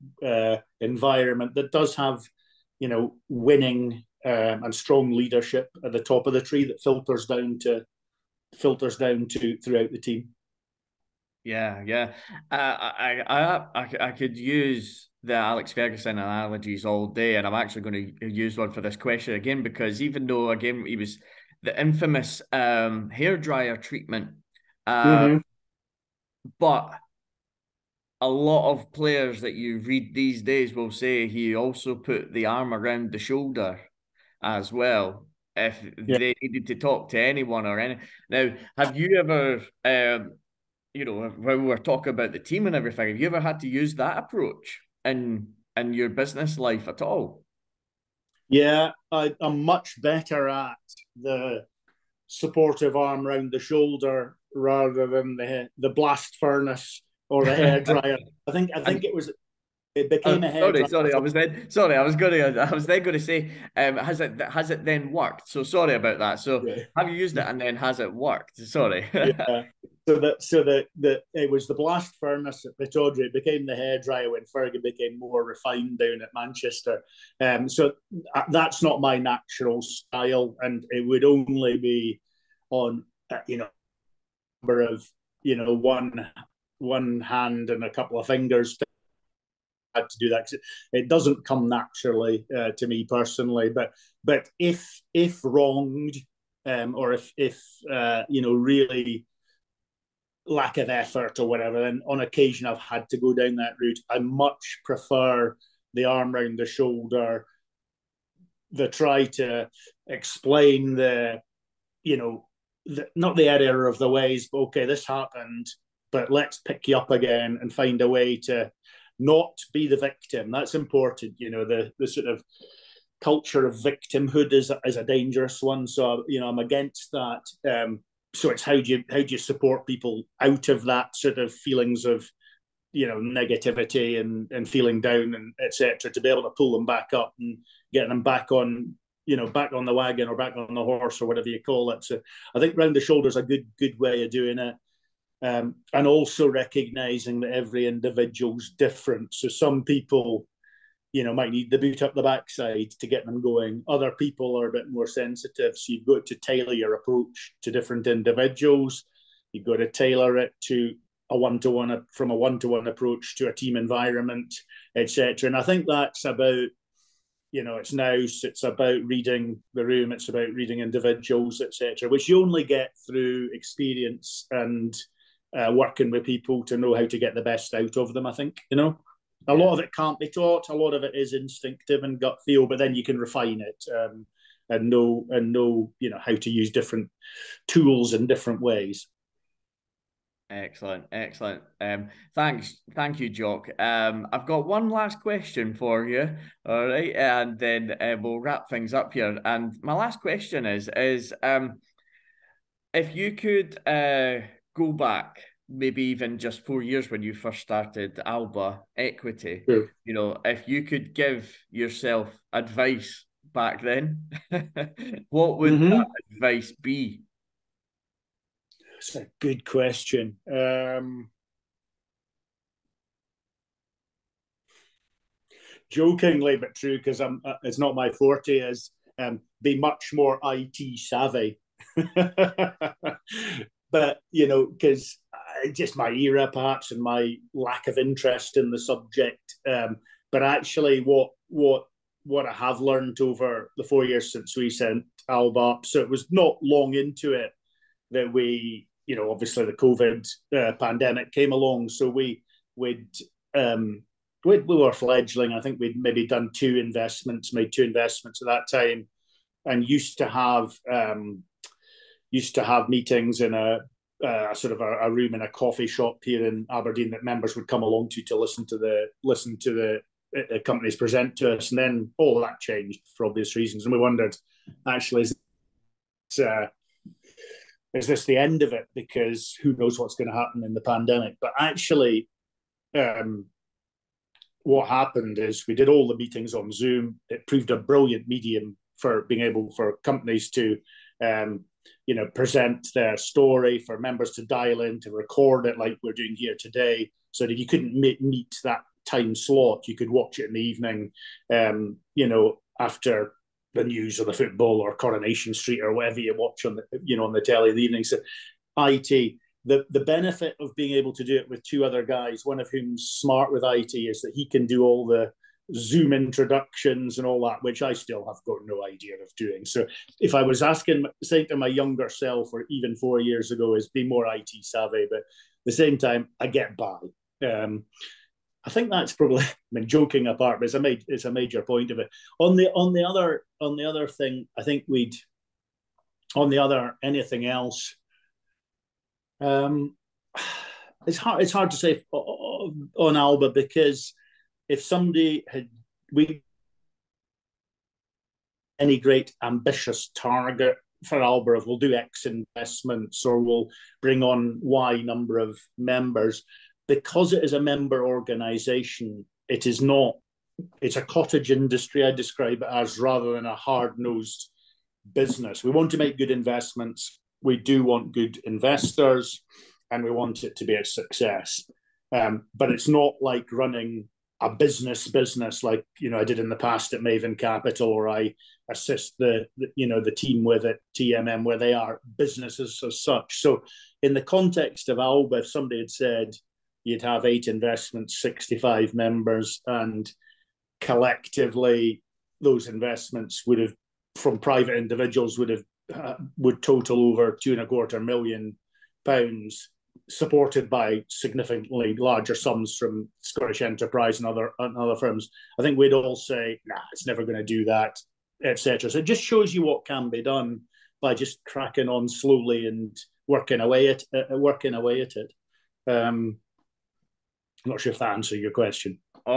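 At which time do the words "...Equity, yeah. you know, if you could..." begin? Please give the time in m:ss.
3:28.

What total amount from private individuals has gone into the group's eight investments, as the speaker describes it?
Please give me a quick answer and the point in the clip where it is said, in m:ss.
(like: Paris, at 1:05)
over £2.25 million, at 6:37.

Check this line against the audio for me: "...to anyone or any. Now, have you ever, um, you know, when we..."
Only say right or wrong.
right.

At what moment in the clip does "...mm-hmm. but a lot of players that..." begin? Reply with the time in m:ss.
0:25.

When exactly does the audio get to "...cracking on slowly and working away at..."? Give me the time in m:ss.
6:51.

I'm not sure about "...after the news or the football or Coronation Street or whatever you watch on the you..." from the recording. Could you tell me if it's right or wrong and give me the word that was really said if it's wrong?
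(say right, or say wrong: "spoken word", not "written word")
right.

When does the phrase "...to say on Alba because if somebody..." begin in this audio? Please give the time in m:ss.
5:41.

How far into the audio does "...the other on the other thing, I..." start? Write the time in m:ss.
5:32.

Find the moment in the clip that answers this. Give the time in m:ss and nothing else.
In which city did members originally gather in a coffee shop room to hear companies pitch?
4:26.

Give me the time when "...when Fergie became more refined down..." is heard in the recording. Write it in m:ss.
1:14.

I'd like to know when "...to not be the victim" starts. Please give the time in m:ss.
1:58.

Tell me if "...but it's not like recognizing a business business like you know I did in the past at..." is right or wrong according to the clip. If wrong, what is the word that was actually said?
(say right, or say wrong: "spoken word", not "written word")
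wrong: "running", not "recognizing".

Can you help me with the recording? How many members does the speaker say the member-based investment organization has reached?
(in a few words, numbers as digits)
65.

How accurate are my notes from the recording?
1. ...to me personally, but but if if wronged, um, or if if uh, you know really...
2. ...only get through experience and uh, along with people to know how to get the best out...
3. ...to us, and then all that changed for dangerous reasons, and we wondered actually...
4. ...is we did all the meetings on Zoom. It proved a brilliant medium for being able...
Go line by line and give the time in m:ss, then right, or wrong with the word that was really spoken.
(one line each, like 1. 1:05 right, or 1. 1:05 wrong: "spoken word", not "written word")
1. 1:32 right
2. 2:52 wrong: "working", not "along"
3. 4:31 wrong: "obvious", not "dangerous"
4. 4:45 right.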